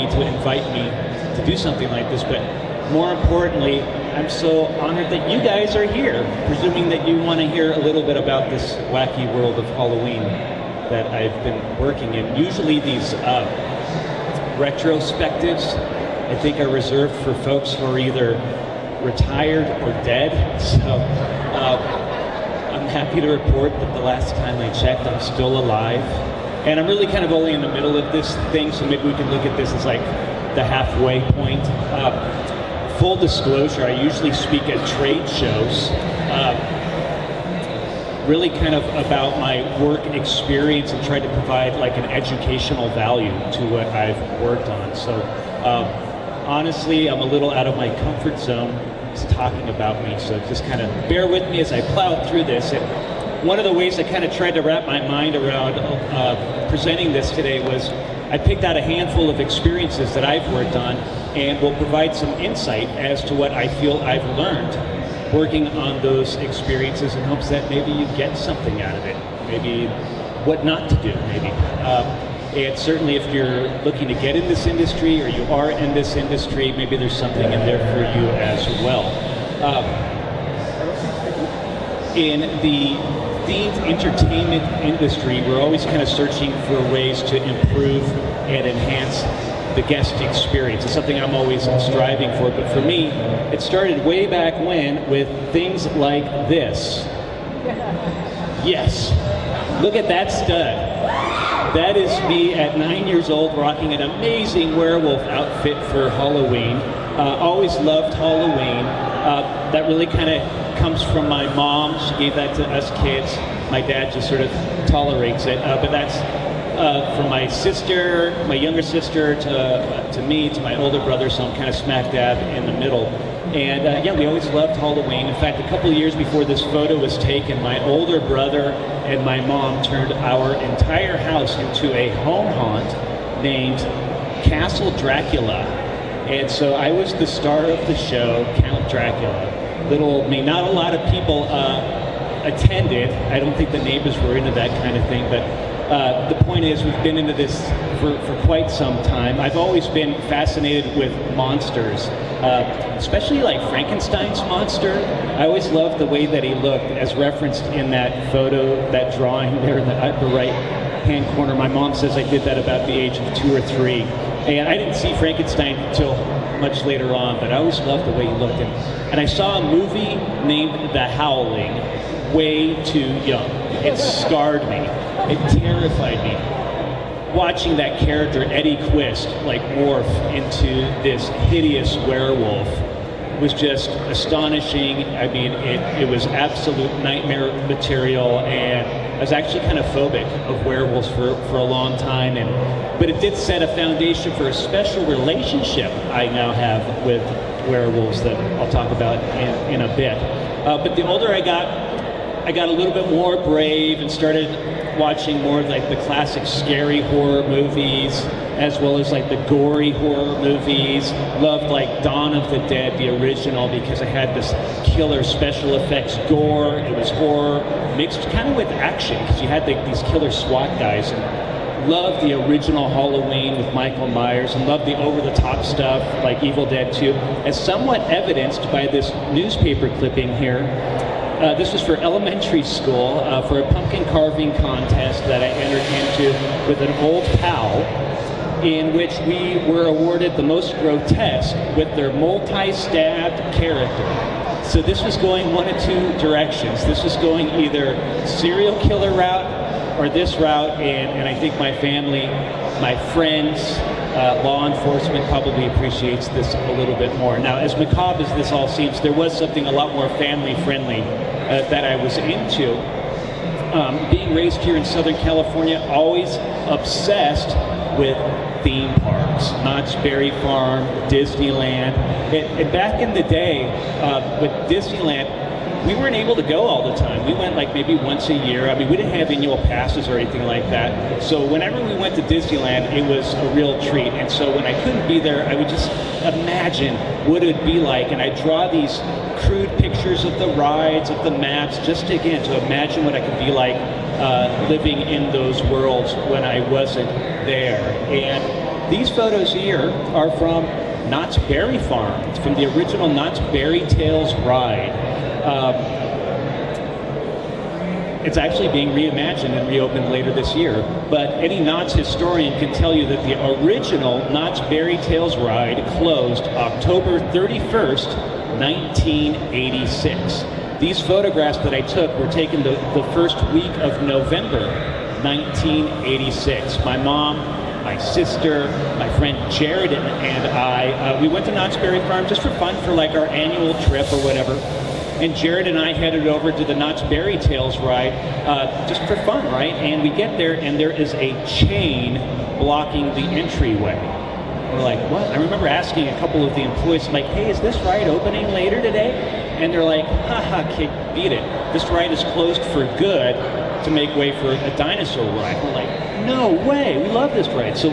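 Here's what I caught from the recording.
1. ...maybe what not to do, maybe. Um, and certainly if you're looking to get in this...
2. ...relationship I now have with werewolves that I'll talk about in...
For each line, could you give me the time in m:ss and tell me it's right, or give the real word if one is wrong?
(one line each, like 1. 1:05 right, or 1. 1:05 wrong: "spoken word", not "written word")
1. 1:09 right
2. 3:15 right.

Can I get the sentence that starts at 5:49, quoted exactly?
And they're like, haha, kid, beat it.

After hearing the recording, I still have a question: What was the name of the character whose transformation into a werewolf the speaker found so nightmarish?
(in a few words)
Eddie Quist.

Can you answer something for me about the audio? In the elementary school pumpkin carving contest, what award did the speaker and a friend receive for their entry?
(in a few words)
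most grotesque.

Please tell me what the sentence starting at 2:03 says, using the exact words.
And uh, yeah, we always loved Halloween.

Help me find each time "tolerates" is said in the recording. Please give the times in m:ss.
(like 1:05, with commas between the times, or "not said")
1:54.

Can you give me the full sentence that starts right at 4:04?
So this was going one of two directions.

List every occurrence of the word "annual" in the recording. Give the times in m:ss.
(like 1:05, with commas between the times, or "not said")
4:39, 5:33.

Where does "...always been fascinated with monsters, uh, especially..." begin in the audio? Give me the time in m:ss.
2:29.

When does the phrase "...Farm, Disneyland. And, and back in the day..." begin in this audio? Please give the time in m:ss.
4:30.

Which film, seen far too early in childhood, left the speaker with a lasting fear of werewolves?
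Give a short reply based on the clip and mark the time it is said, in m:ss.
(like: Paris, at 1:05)
The Howling, at 2:50.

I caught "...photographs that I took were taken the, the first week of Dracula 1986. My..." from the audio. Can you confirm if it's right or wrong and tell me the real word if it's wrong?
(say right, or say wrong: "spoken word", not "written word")
wrong: "November", not "Dracula".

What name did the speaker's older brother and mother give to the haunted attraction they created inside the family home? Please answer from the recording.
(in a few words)
Castle Dracula.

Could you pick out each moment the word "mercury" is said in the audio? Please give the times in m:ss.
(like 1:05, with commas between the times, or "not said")
not said.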